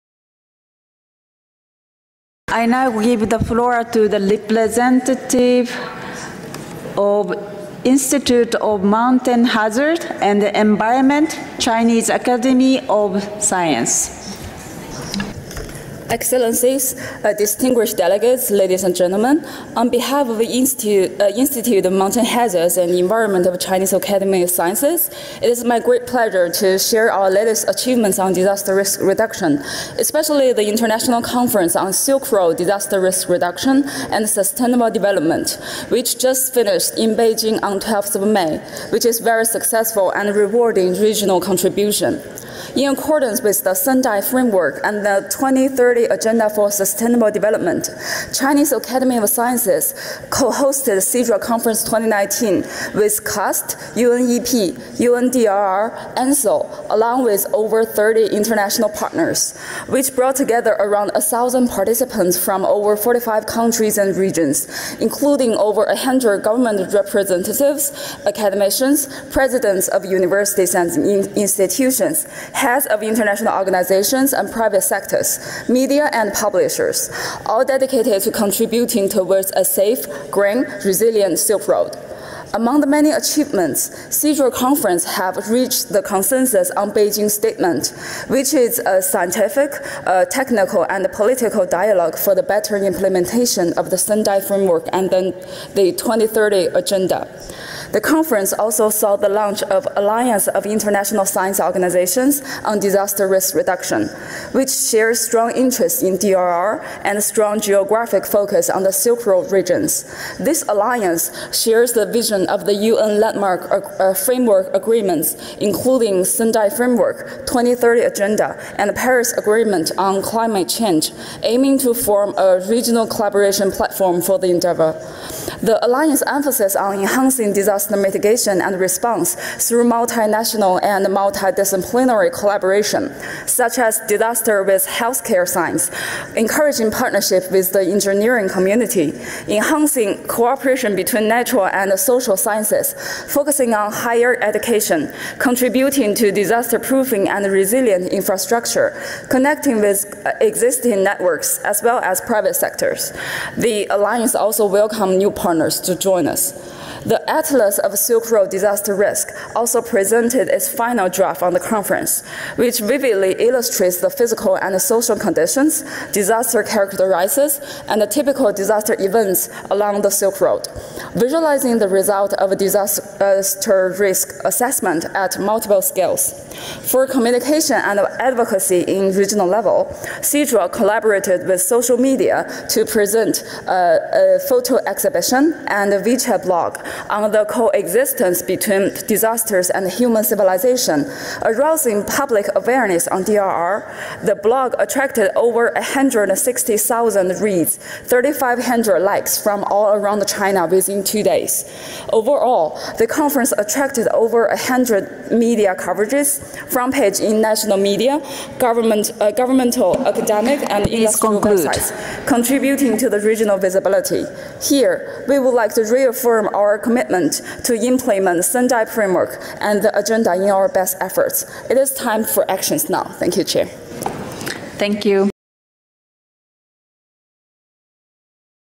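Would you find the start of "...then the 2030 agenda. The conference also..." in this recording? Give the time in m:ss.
1:35.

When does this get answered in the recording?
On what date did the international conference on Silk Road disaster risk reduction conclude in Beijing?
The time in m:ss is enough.
0:37.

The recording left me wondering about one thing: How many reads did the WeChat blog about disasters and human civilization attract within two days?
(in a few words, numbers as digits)
160,000.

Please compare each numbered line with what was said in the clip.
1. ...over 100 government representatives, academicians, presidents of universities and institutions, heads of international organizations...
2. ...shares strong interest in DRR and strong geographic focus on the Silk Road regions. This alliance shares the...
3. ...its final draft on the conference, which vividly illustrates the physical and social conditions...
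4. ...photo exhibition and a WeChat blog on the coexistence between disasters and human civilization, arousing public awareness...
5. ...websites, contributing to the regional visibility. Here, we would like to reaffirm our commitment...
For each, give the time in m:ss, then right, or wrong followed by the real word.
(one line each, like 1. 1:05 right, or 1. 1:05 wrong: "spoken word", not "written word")
1. 1:05 right
2. 1:44 right
3. 2:40 right
4. 3:04 right
5. 3:31 right.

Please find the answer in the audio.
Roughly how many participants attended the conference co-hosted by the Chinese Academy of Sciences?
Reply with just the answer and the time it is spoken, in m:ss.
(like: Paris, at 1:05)
1,000, at 1:01.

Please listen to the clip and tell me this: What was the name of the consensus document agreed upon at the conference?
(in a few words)
Beijing statement.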